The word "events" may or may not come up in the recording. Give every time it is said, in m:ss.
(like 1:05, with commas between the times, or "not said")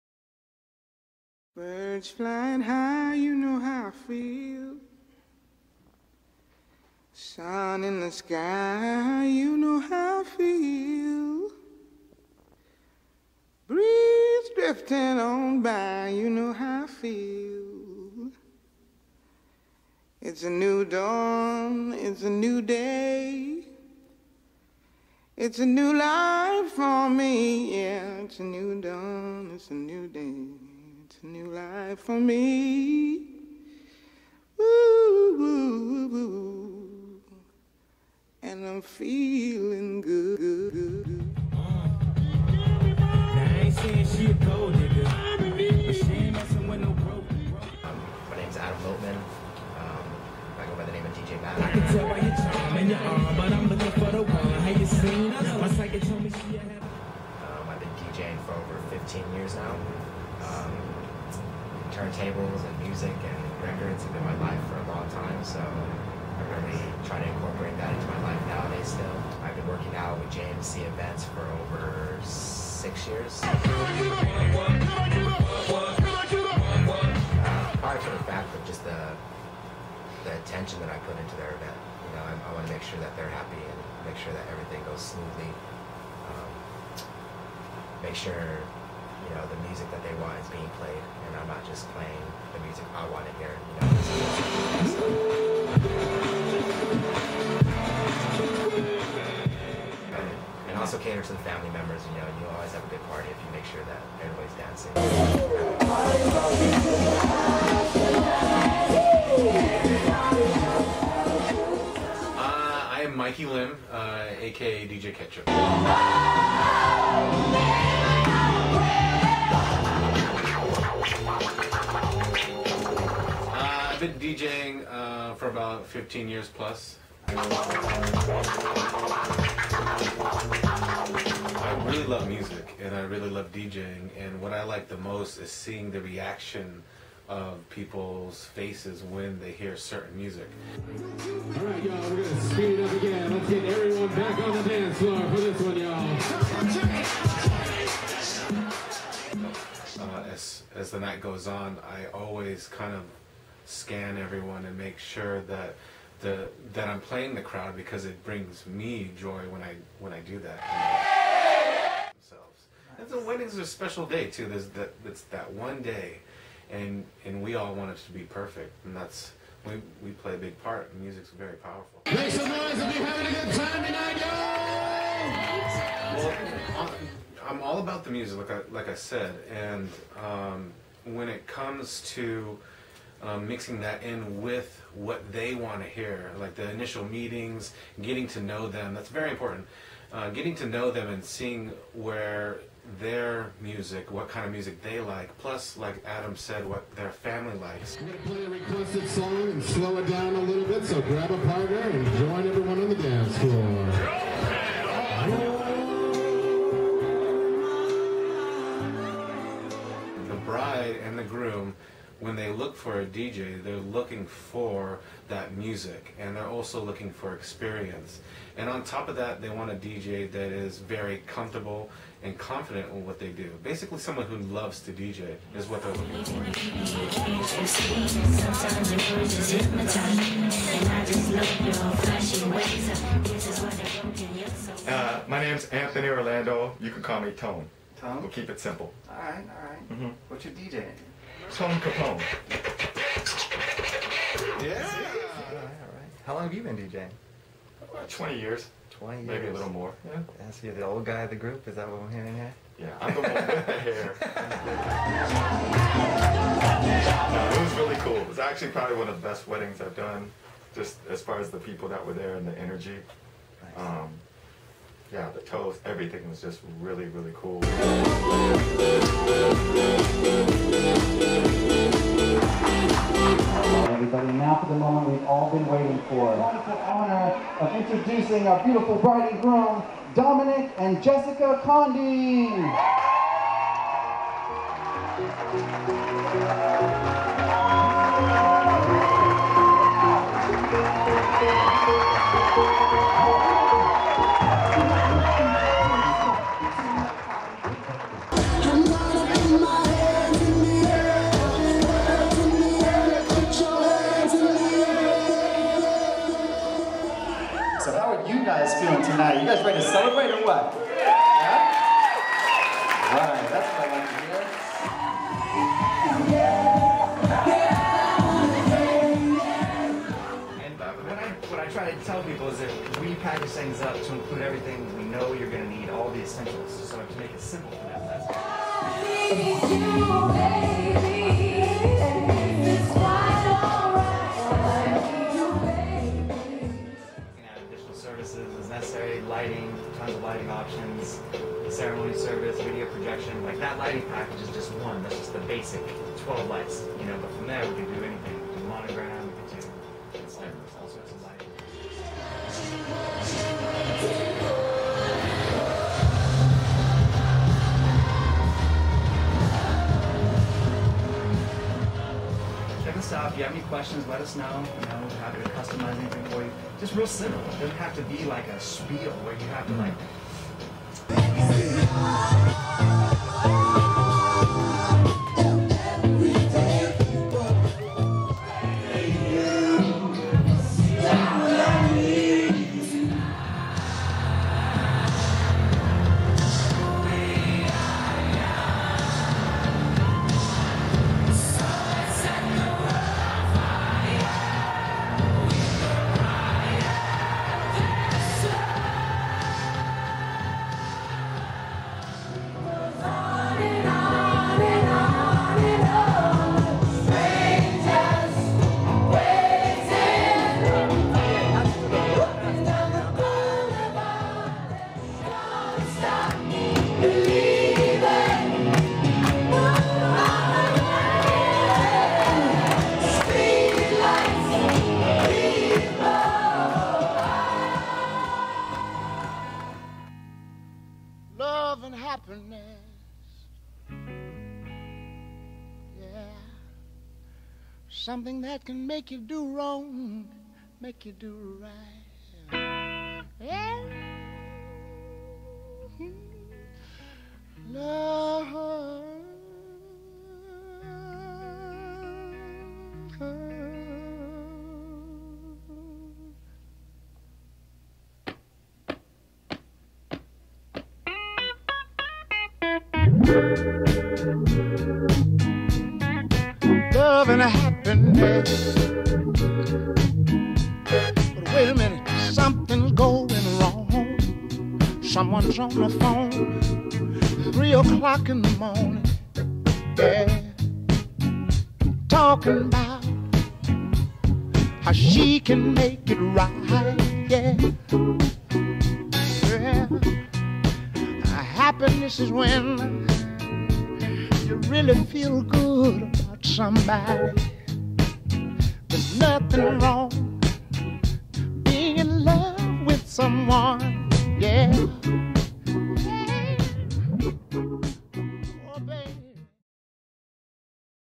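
1:10, 1:21.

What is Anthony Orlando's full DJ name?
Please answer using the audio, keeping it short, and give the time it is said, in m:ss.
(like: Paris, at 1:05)
Tone Capone, at 4:01.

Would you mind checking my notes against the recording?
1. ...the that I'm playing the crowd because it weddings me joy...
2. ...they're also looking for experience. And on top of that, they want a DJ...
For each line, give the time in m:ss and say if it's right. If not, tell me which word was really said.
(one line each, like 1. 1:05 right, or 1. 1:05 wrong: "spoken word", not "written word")
1. 2:36 wrong: "brings", not "weddings"
2. 3:36 right.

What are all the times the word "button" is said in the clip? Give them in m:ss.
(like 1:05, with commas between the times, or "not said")
not said.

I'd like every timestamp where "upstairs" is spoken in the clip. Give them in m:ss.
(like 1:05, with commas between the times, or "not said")
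not said.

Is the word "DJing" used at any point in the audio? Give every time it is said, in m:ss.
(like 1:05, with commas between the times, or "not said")
0:57, 2:04, 2:13, 4:06.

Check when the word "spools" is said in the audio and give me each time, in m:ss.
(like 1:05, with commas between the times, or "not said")
not said.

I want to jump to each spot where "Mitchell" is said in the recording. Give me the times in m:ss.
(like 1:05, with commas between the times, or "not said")
not said.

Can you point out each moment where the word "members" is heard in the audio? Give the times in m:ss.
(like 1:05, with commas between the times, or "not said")
1:41.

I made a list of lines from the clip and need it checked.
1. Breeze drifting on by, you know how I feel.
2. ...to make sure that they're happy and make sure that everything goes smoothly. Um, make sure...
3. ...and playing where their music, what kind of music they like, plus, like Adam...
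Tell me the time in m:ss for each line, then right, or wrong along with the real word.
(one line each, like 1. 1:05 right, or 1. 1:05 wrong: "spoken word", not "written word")
1. 0:13 right
2. 1:22 right
3. 3:11 wrong: "seeing", not "playing".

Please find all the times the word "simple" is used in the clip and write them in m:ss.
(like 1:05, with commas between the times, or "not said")
3:58, 5:27, 6:07.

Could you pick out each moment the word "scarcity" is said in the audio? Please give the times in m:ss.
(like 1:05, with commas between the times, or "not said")
not said.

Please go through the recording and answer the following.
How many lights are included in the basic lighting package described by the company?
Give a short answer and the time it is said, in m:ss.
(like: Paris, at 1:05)
12, at 5:46.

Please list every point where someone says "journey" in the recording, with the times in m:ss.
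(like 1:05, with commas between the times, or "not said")
not said.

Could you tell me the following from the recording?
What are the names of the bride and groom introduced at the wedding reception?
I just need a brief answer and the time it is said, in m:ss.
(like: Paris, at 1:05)
Dominic and Jessica Condi, at 4:40.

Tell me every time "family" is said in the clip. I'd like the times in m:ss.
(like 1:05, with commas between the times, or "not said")
1:41, 3:17.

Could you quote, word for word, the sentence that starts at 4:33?
Everybody, now for the moment we've all been waiting for.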